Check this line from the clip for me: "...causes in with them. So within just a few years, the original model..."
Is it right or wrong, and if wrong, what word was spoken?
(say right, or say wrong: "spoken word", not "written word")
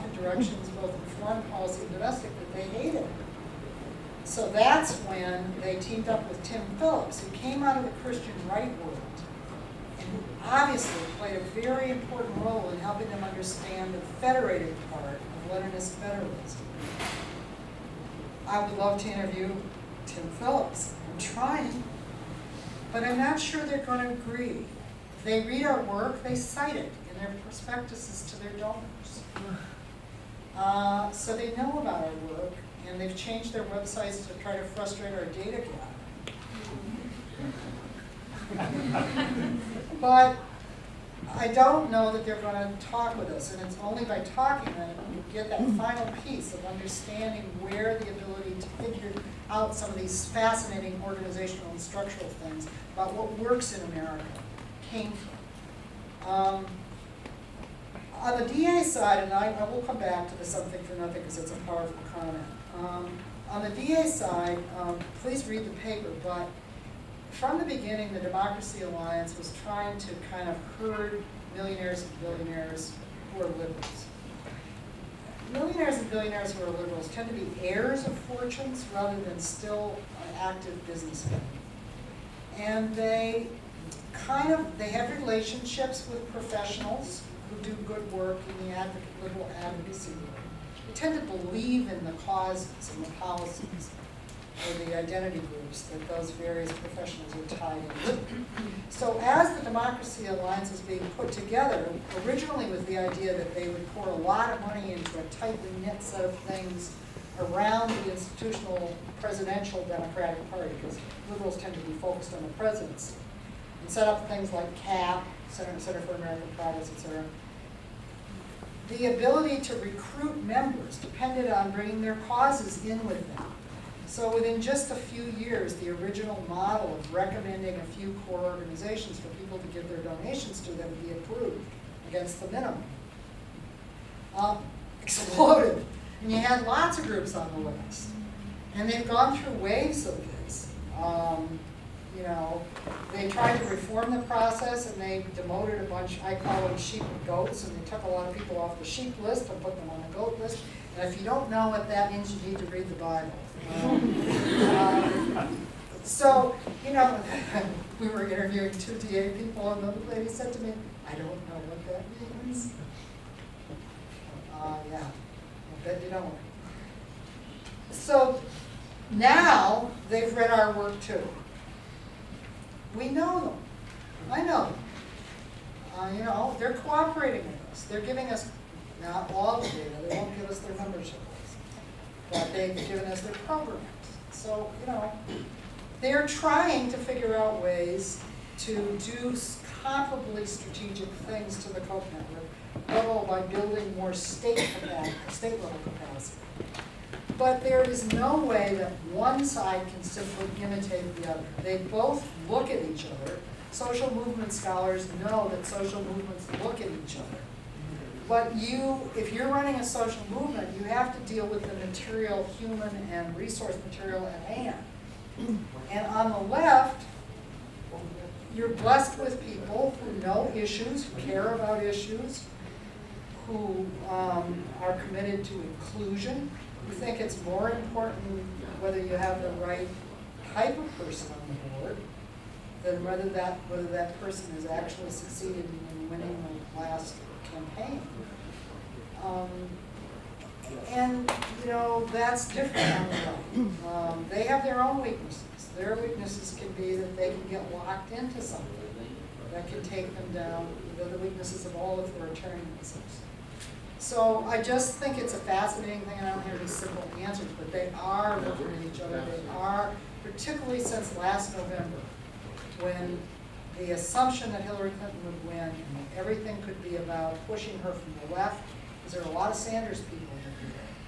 right.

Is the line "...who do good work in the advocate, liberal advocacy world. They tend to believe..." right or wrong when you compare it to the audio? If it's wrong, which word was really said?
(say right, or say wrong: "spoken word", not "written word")
right.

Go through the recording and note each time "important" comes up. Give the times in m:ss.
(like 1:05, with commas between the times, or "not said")
0:11, 3:47.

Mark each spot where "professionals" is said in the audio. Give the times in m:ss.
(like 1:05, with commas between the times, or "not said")
1:26, 1:36.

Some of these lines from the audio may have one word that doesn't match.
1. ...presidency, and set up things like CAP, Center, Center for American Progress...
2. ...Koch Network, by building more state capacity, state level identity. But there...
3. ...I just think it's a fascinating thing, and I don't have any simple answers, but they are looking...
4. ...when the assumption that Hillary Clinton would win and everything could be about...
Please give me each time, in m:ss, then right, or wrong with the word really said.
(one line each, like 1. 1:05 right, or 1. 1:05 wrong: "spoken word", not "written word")
1. 1:52 right
2. 3:11 wrong: "capacity", not "identity"
3. 4:14 right
4. 4:22 right.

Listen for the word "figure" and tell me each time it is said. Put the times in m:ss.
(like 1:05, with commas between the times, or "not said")
0:48, 3:06.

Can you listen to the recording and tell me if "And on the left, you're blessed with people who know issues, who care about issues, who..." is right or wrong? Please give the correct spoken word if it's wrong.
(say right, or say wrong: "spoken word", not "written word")
right.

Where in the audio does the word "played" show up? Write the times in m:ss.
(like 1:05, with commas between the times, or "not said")
0:11.